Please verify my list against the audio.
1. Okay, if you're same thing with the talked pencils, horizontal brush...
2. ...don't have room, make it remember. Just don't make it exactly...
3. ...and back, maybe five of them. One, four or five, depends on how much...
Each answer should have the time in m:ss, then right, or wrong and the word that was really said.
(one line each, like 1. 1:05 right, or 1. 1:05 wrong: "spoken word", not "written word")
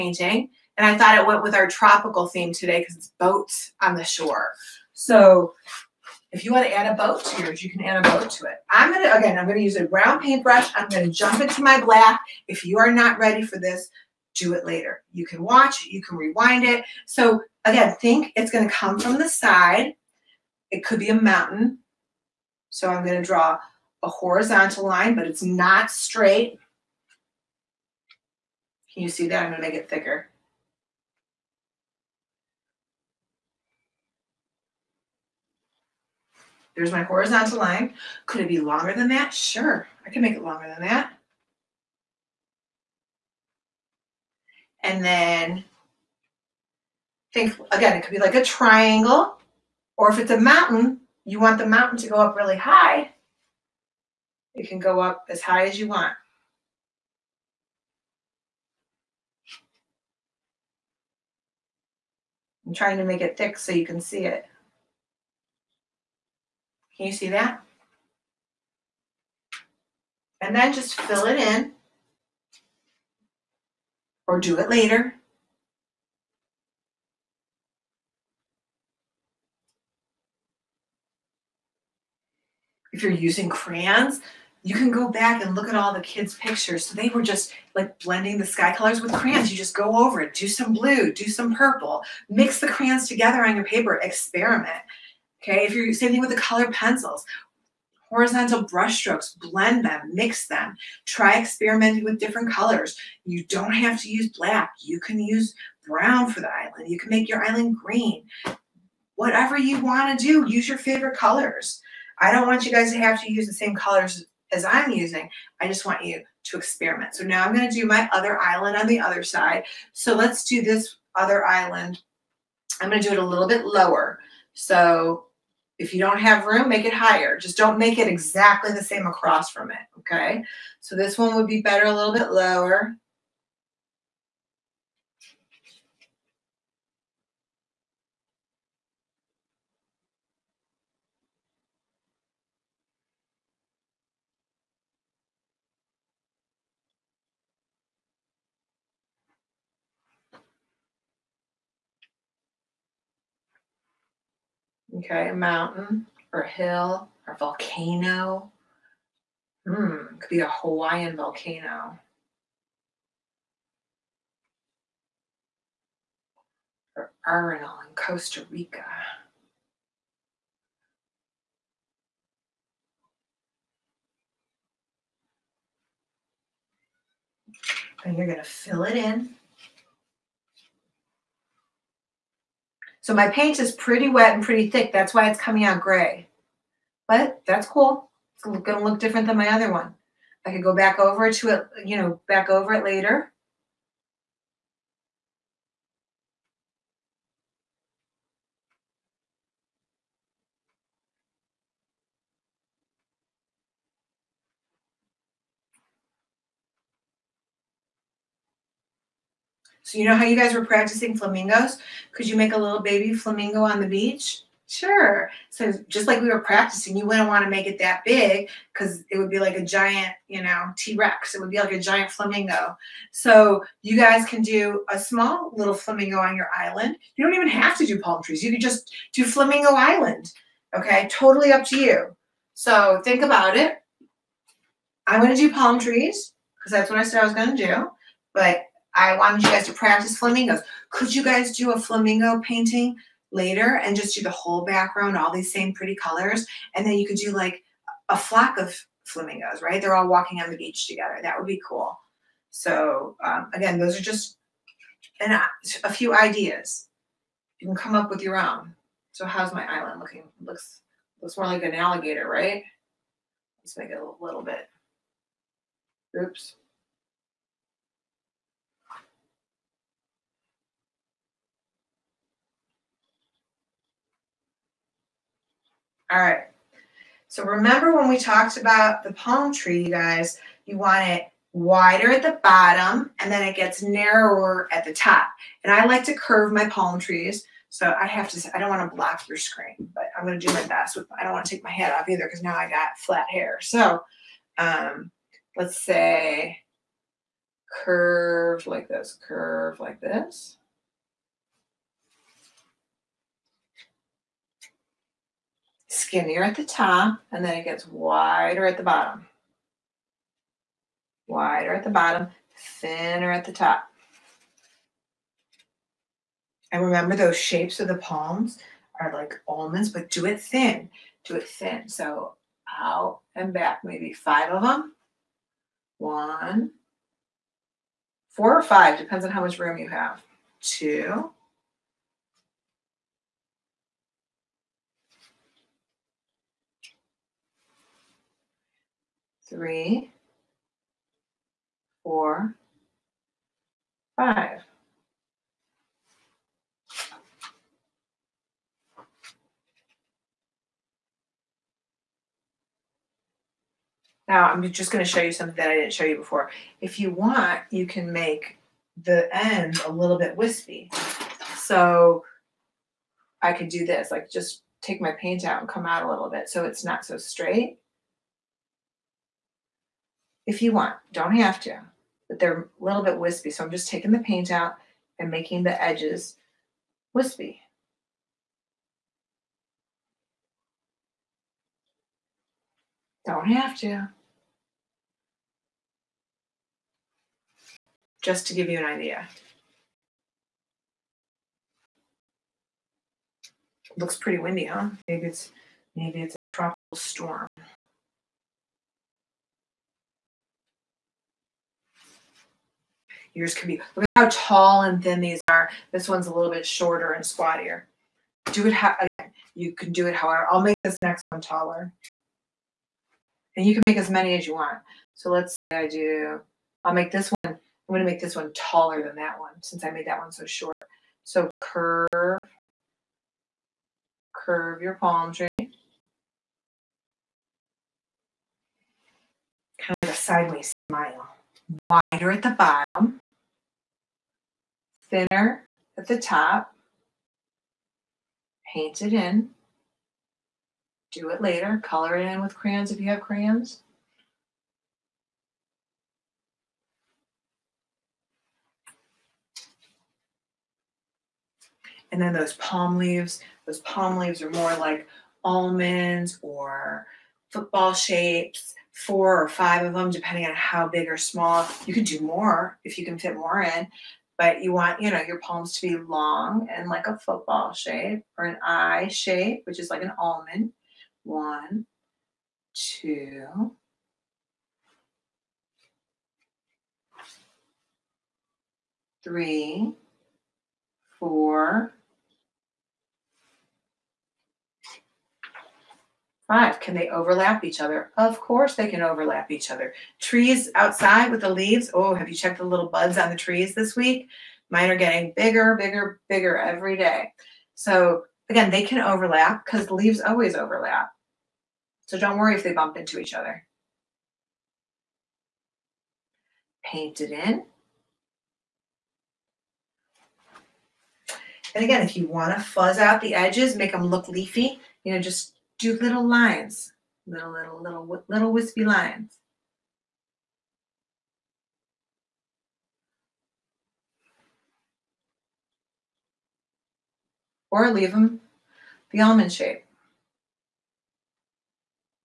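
1. 1:35 wrong: "colored", not "talked"
2. 2:05 wrong: "higher", not "remember"
3. 5:23 right.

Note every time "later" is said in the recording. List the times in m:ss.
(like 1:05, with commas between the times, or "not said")
0:14, 1:14, 3:12, 4:03, 7:21.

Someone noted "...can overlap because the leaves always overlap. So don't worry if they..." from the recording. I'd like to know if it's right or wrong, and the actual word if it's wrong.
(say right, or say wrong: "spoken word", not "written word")
right.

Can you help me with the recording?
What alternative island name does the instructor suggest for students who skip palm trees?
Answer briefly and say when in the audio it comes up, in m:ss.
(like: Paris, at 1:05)
Flamingo Island, at 3:49.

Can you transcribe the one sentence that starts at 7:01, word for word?
So curve, curve your palm tree.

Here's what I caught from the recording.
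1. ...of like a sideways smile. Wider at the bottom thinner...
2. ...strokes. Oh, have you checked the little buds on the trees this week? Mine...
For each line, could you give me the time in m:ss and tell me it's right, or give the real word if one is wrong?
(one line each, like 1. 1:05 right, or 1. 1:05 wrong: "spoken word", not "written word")
1. 7:10 right
2. 8:11 wrong: "leaves", not "strokes".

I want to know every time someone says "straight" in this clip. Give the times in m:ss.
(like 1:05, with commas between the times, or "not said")
0:25, 6:07.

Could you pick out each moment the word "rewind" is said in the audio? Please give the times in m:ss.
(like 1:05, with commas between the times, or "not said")
0:16.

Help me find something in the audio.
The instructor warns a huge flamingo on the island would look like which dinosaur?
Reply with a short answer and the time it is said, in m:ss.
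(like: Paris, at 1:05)
T-Rex, at 3:40.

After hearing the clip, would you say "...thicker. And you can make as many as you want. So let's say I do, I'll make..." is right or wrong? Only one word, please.
wrong.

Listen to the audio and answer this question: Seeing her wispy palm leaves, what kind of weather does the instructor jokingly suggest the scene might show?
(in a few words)
Tropical storm.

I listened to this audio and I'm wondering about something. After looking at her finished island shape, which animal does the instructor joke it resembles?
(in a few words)
An alligator.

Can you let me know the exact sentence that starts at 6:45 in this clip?
This one's a little bit shorter and squattier.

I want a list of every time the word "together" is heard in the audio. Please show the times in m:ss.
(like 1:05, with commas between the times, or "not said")
1:33, 4:10.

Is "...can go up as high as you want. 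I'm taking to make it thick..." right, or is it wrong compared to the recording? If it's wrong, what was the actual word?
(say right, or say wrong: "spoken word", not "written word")
wrong: "trying", not "taking".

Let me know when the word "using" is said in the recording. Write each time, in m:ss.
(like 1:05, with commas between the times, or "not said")
1:23, 1:54.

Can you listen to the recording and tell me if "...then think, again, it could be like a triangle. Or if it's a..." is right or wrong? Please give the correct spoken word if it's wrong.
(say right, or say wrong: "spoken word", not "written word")
right.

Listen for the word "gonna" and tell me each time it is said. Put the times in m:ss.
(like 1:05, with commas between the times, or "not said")
6:57.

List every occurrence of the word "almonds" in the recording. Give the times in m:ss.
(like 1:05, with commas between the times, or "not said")
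5:19, 7:35, 7:50, 8:49.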